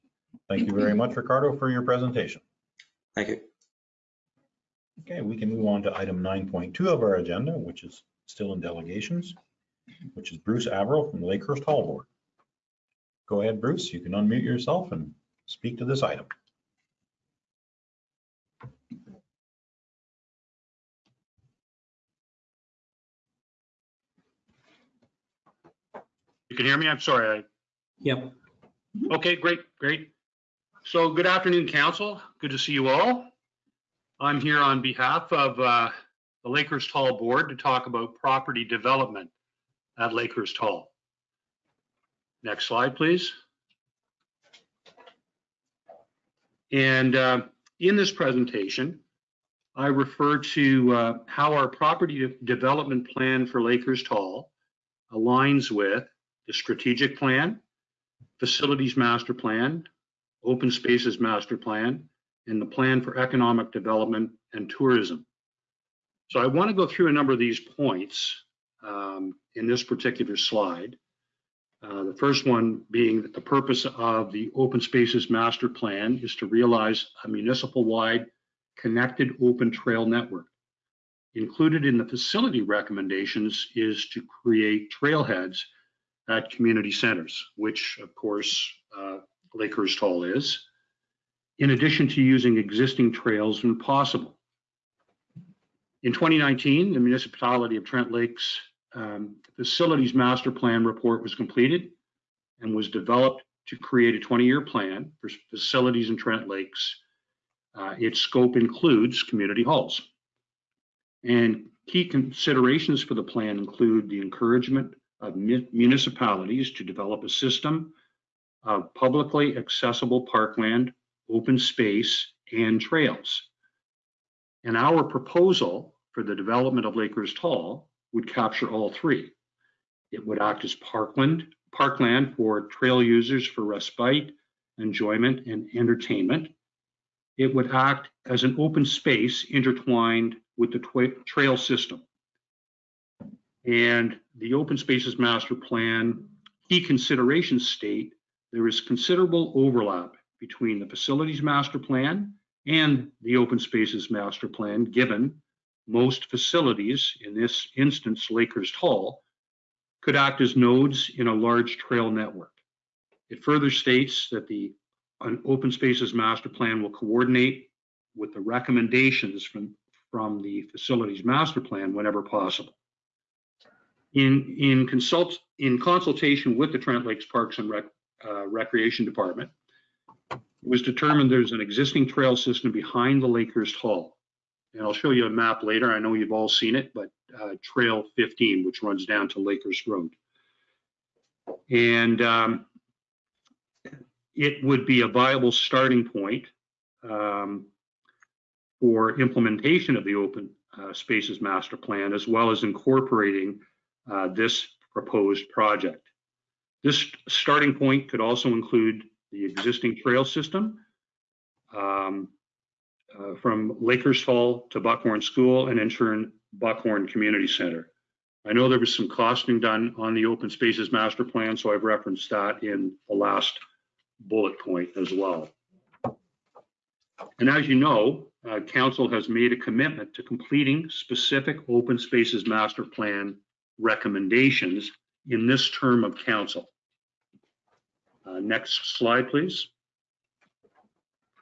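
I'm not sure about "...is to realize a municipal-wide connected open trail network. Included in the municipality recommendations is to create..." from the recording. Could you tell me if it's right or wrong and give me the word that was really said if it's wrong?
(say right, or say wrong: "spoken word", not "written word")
wrong: "facility", not "municipality".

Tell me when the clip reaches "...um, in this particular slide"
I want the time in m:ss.
1:08.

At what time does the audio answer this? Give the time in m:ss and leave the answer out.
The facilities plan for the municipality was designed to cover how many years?
1:44.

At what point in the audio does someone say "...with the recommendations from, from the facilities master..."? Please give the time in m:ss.
2:48.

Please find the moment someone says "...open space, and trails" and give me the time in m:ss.
2:01.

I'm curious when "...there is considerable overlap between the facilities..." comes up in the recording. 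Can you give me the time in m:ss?
2:28.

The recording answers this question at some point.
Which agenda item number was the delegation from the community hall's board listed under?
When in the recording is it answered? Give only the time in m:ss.
0:06.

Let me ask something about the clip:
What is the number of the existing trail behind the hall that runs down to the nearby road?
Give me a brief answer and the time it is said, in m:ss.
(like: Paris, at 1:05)
15, at 3:07.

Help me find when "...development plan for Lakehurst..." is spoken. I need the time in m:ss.
0:52.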